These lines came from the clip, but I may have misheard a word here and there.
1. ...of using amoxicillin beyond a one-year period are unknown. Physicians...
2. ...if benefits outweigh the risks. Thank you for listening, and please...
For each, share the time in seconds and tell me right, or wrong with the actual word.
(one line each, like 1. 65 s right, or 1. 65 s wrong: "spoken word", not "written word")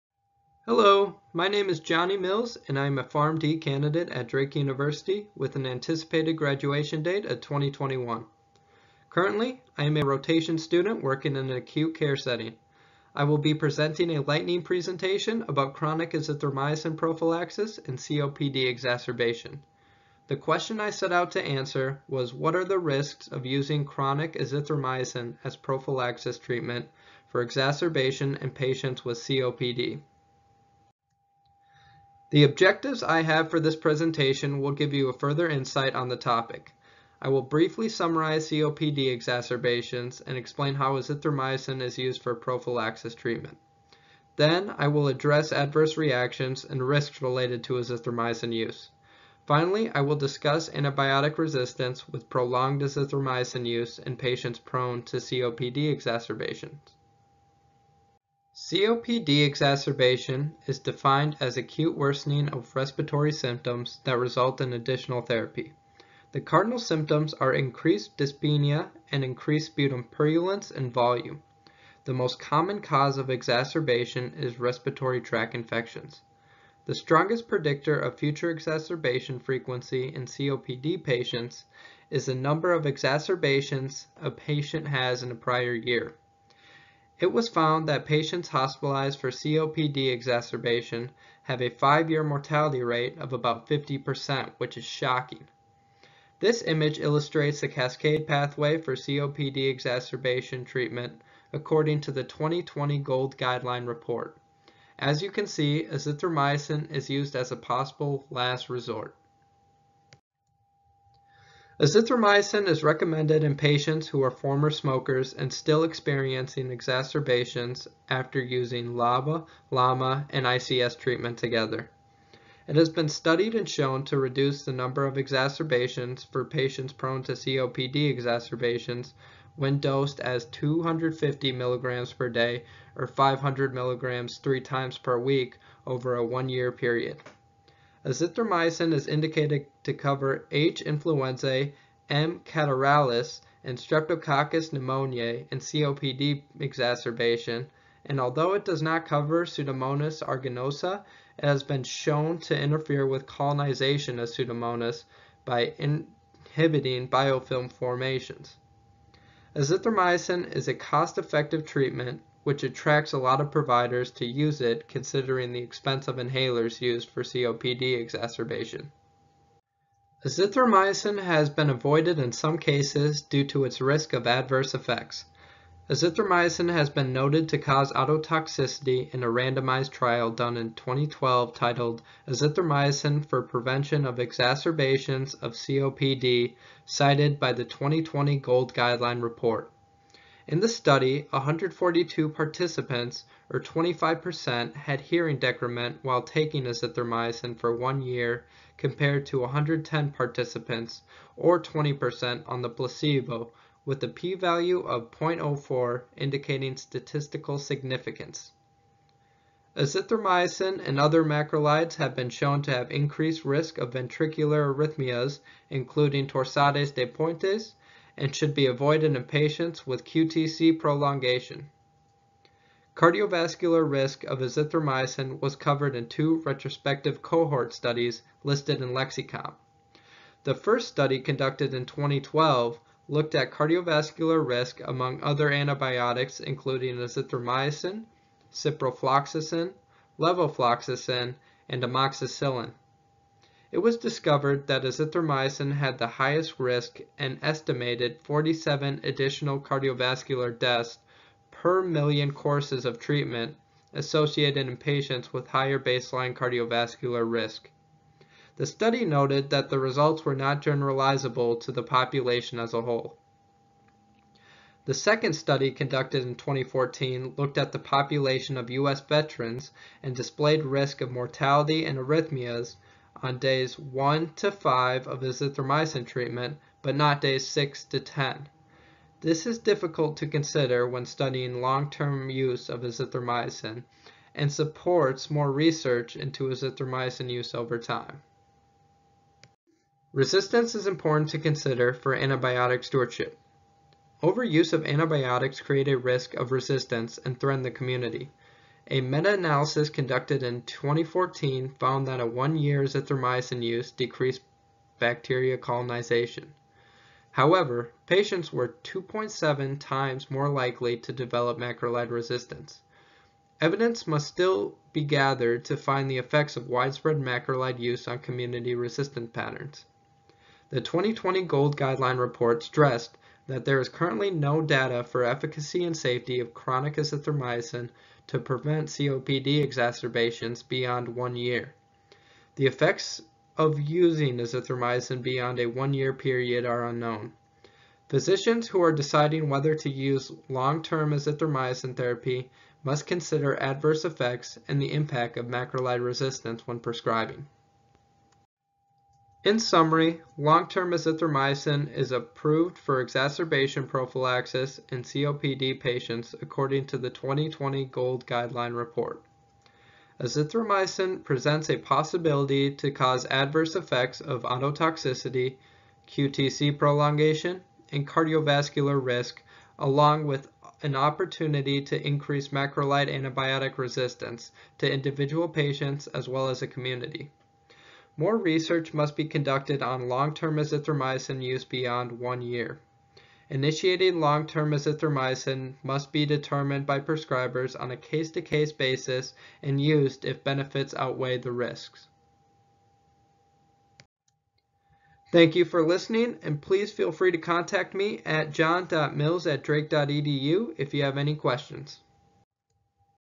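1. 333 s wrong: "azithromycin", not "amoxicillin"
2. 390 s right.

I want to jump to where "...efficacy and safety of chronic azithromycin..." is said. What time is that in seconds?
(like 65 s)
325 s.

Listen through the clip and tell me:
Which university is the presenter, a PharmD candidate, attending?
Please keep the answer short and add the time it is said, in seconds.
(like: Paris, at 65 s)
Drake University, at 4 s.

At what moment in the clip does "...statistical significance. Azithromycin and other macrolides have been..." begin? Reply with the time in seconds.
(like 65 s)
206 s.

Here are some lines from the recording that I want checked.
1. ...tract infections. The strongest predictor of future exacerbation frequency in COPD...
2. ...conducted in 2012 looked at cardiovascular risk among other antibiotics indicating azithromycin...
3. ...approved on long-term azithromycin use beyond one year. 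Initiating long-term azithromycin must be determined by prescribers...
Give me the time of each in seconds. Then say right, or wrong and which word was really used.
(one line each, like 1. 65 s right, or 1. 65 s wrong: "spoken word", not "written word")
1. 75 s right
2. 231 s wrong: "including", not "indicating"
3. 379 s wrong: "conducted", not "approved".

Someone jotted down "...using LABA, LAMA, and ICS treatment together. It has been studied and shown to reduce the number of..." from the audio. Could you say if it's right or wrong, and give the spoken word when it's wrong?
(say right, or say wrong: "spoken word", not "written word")
right.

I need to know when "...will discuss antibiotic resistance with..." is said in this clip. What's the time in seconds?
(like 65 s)
49 s.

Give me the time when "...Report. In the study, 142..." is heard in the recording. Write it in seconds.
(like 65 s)
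189 s.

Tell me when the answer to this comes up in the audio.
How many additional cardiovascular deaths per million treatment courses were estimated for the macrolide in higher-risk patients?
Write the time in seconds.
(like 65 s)
248 s.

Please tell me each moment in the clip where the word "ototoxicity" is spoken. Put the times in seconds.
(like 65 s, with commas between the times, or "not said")
177 s, 364 s.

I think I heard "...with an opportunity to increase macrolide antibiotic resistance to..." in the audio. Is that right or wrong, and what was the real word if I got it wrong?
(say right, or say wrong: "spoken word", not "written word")
right.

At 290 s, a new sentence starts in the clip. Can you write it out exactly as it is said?
Resistance is important to consider for antibiotic stewardship.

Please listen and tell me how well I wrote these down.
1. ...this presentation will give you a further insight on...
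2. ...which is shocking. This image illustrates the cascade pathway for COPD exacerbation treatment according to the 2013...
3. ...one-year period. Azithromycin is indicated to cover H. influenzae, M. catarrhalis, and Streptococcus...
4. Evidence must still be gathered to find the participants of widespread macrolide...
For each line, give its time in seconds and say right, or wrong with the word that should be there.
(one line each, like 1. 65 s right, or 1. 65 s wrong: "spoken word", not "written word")
1. 33 s right
2. 94 s wrong: "2020", not "2013"
3. 136 s right
4. 313 s wrong: "effects", not "participants".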